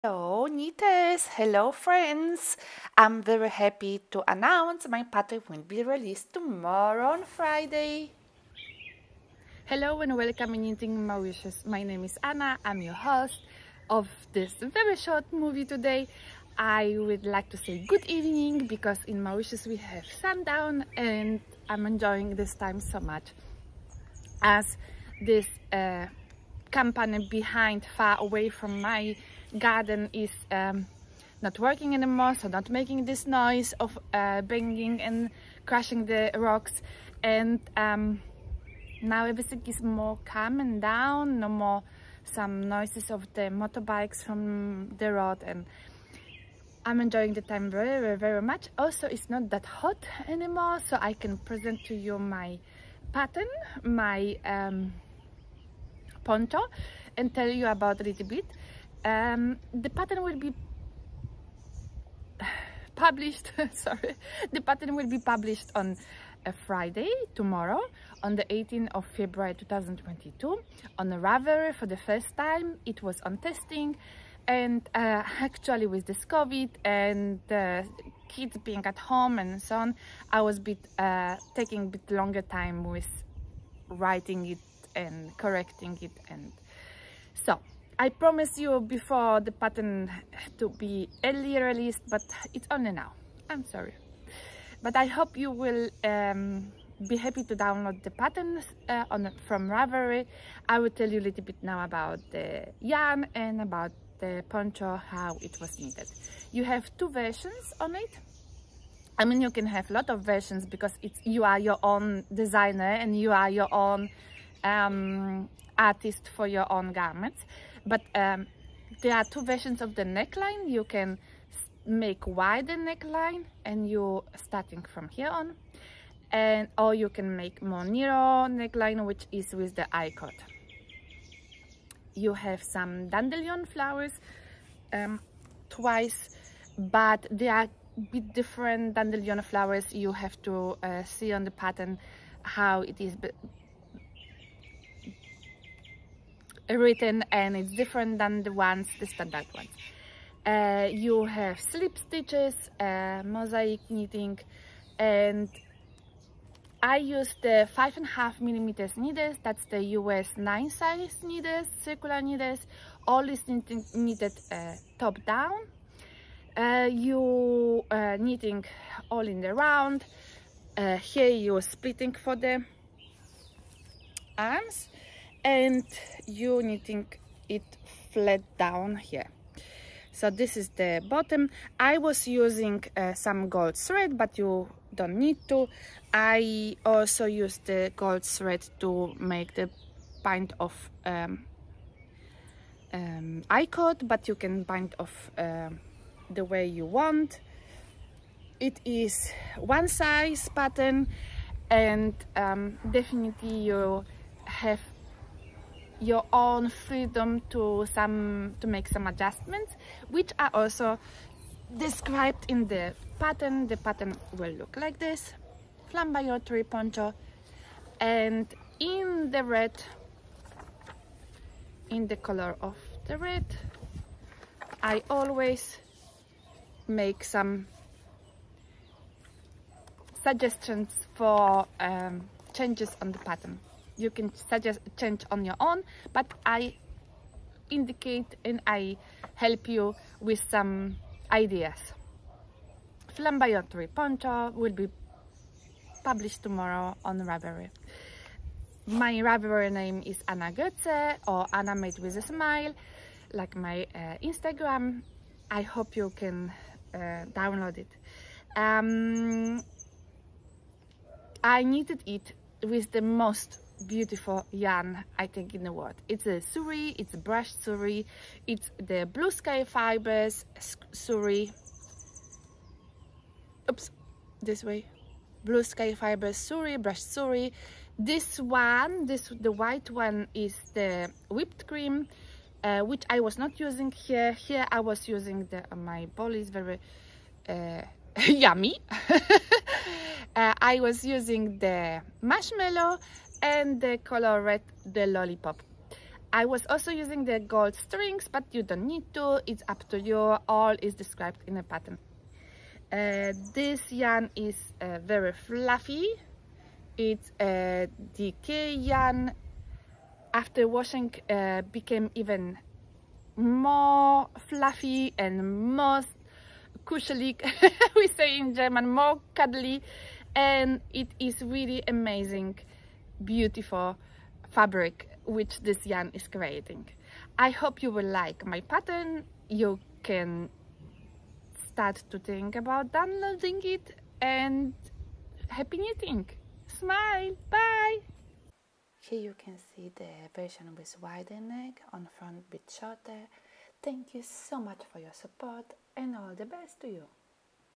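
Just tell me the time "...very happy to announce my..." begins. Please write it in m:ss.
0:03.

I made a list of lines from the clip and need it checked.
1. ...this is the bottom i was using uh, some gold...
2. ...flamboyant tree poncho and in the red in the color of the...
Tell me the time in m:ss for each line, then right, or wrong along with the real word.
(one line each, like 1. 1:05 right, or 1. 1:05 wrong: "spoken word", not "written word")
1. 3:00 right
2. 3:35 right.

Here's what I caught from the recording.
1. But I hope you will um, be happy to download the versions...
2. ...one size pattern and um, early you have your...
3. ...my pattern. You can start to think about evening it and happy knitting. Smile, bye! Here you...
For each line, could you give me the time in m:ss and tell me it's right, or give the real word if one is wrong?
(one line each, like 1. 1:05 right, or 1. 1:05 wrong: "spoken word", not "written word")
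1. 1:34 wrong: "patterns", not "versions"
2. 3:19 wrong: "definitely", not "early"
3. 5:28 wrong: "downloading", not "evening".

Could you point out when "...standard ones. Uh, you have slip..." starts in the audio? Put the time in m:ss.
2:29.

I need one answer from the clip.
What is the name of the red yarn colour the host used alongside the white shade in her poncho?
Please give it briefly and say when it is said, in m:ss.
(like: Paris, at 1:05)
Lollipop, at 4:54.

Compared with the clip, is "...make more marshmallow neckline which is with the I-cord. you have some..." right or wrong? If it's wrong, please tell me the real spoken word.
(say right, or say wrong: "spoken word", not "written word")
wrong: "narrow", not "marshmallow".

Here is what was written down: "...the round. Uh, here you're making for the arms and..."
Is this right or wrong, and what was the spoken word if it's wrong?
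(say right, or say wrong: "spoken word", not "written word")
wrong: "splitting", not "making".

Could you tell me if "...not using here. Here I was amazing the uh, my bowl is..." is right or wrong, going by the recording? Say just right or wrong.
wrong.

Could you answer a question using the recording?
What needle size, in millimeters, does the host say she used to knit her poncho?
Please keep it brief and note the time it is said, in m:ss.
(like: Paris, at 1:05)
5.5 millimeters, at 2:37.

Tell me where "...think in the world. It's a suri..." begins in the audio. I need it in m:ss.
4:25.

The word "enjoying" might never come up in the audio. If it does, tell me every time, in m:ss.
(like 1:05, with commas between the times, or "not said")
0:21, 0:47.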